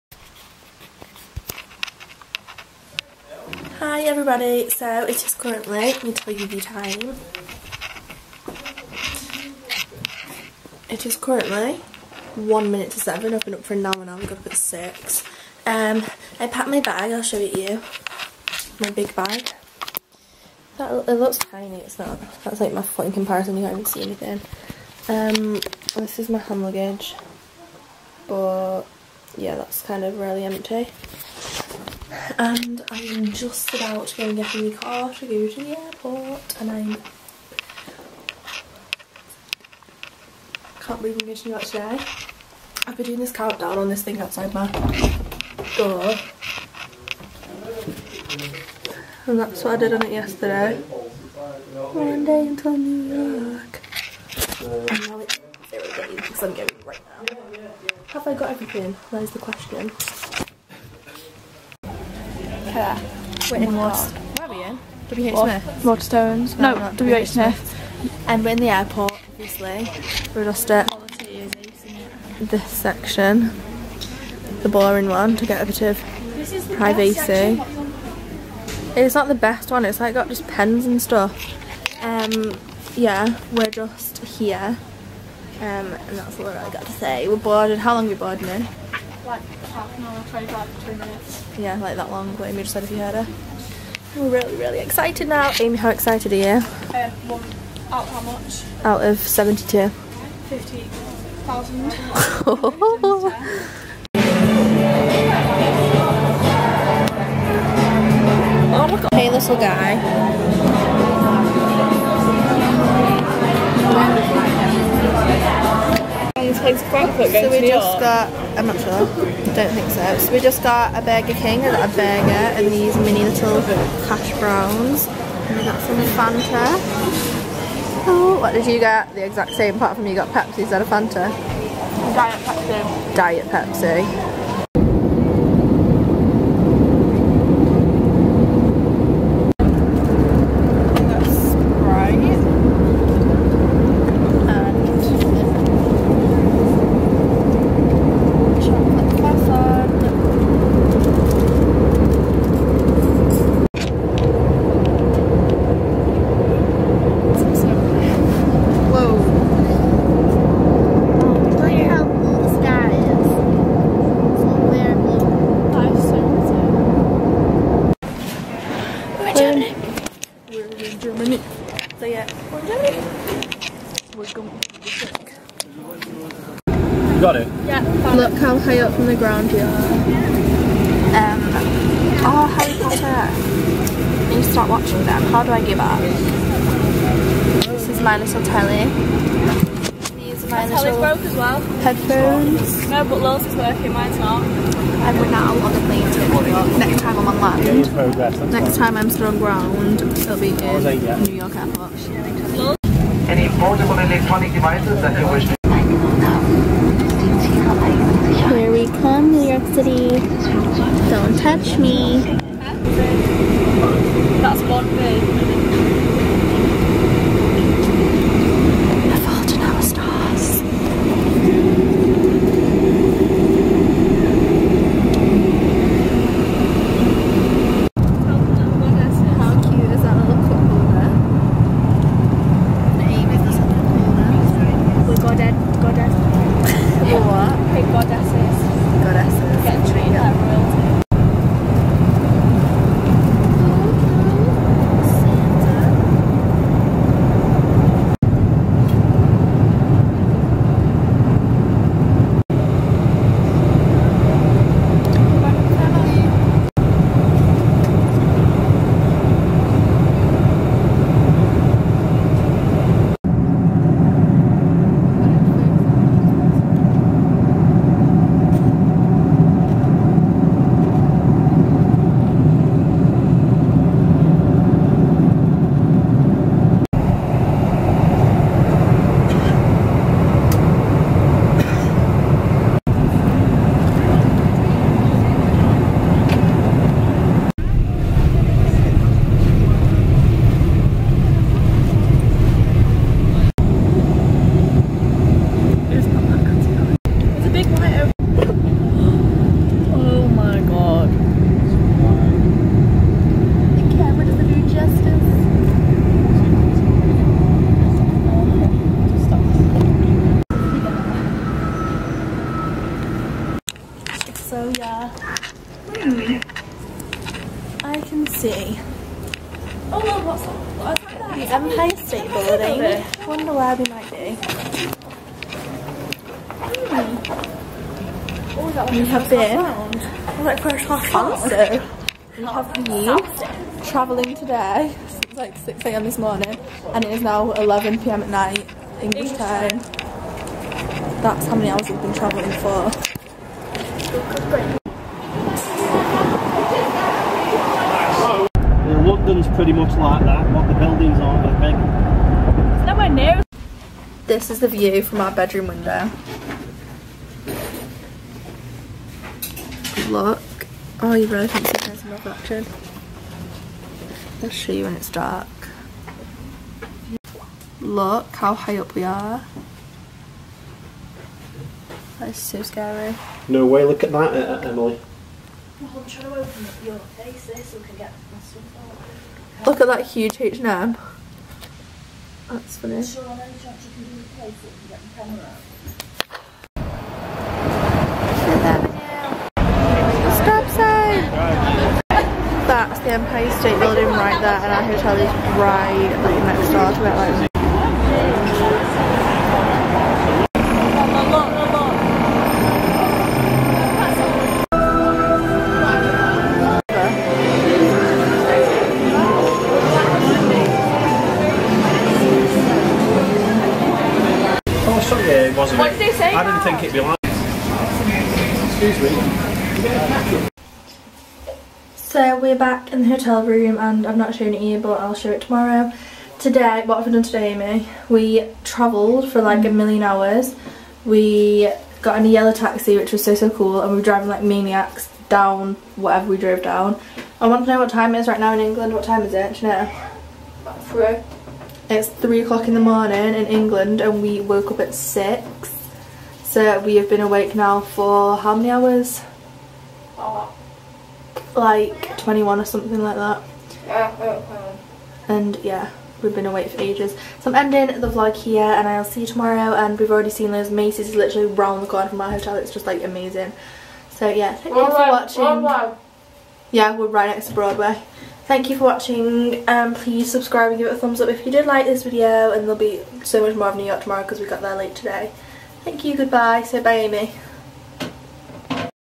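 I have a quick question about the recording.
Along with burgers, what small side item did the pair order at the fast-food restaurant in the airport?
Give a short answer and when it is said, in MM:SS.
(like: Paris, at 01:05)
Hash browns, at 02:02.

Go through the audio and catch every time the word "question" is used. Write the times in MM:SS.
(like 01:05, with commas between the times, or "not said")
00:59.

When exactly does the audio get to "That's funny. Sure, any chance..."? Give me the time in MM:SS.
06:22.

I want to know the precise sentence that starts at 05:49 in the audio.
London's pretty much like that, what the buildings are, I think.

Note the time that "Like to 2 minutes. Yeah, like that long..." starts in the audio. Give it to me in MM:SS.
01:29.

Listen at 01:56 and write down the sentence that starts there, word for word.
Frankfurt going so we to just got, I'm not sure, don't think so.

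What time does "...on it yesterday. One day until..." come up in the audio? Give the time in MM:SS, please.
00:49.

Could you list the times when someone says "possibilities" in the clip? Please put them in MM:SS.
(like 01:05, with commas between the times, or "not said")
not said.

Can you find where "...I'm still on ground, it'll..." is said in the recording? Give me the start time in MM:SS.
03:18.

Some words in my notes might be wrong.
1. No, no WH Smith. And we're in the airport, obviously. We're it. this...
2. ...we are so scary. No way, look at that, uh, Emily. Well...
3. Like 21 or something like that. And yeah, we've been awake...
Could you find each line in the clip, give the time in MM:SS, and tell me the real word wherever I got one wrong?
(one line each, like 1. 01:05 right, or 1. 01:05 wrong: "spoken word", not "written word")
1. 01:06 right
2. 06:08 right
3. 07:31 right.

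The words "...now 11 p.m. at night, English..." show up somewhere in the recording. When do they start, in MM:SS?
05:37.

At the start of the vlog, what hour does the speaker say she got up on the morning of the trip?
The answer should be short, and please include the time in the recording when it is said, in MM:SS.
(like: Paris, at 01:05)
6, at 00:14.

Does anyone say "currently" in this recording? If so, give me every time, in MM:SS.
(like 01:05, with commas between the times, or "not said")
00:05, 00:11.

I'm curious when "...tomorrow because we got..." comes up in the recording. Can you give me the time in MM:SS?
07:54.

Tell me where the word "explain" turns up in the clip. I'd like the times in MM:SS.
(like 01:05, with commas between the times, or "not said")
not said.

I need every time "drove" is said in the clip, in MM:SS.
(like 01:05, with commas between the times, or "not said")
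07:16.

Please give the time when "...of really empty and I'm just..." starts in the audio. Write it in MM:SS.
00:30.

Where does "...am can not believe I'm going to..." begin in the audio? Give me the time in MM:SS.
00:36.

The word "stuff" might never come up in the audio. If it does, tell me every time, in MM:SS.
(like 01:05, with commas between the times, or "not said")
01:21, 06:18.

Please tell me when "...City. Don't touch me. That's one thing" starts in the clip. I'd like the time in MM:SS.
03:29.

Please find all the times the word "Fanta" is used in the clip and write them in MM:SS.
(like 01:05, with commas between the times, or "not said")
02:06, 02:10.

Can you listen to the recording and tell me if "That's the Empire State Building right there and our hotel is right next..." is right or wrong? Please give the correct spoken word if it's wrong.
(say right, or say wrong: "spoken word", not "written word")
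right.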